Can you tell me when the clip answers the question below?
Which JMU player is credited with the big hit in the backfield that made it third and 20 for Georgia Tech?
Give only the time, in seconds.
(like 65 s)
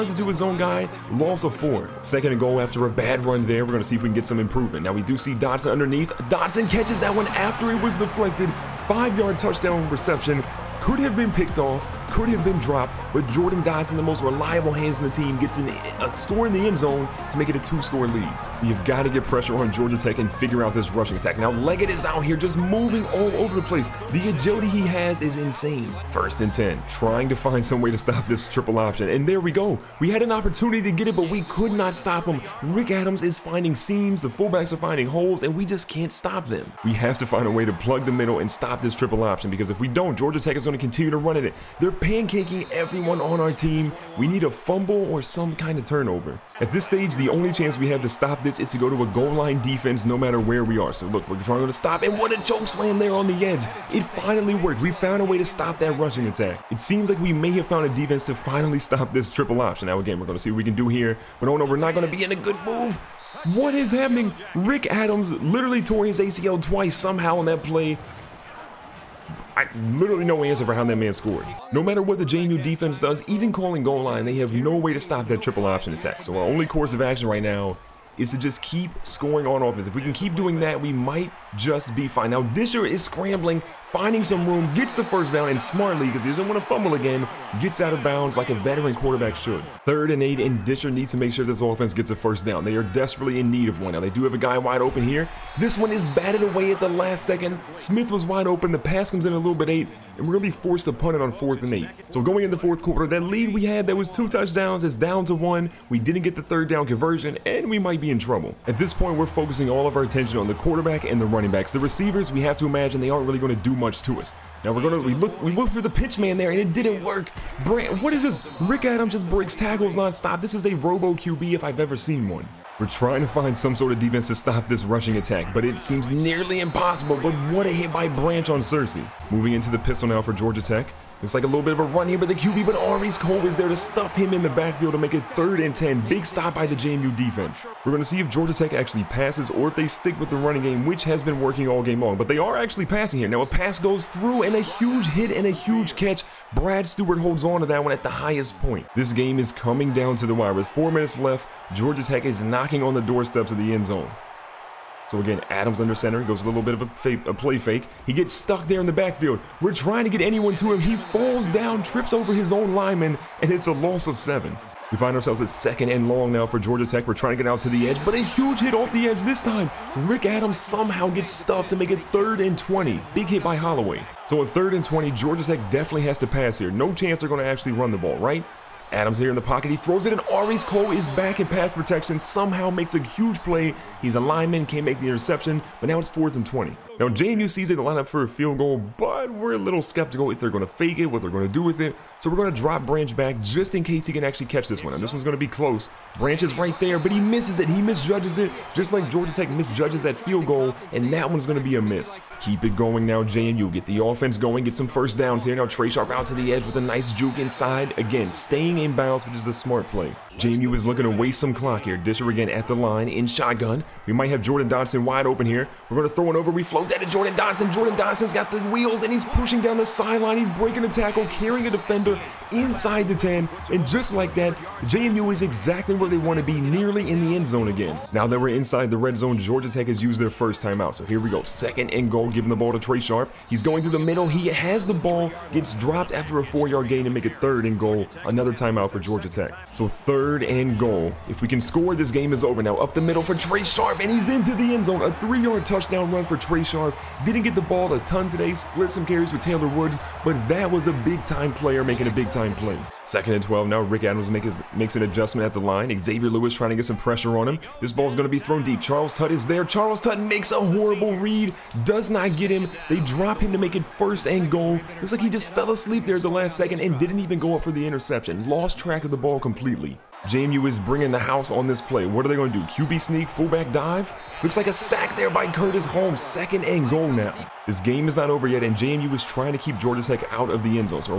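173 s.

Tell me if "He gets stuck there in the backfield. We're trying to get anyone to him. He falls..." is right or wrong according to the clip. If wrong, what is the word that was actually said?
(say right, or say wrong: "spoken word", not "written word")
right.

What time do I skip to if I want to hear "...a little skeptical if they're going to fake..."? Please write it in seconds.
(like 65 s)
189 s.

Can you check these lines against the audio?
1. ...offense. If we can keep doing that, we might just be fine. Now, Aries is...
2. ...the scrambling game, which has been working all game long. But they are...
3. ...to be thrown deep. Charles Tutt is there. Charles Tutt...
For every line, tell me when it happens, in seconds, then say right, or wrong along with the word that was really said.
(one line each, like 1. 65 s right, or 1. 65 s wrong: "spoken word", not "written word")
1. 79 s wrong: "Disher", not "Aries"
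2. 140 s wrong: "running", not "scrambling"
3. 258 s right.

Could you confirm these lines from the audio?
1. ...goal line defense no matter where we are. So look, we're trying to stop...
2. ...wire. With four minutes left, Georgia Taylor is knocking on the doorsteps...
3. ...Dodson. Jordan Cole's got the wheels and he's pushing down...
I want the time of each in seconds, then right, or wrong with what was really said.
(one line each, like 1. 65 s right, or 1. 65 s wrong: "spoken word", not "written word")
1. 49 s right
2. 150 s wrong: "Tech", not "Taylor"
3. 217 s wrong: "Dodson", not "Cole".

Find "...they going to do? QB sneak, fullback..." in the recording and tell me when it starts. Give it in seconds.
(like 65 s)
272 s.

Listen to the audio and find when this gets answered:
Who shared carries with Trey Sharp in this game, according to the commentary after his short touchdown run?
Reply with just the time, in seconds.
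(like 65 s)
249 s.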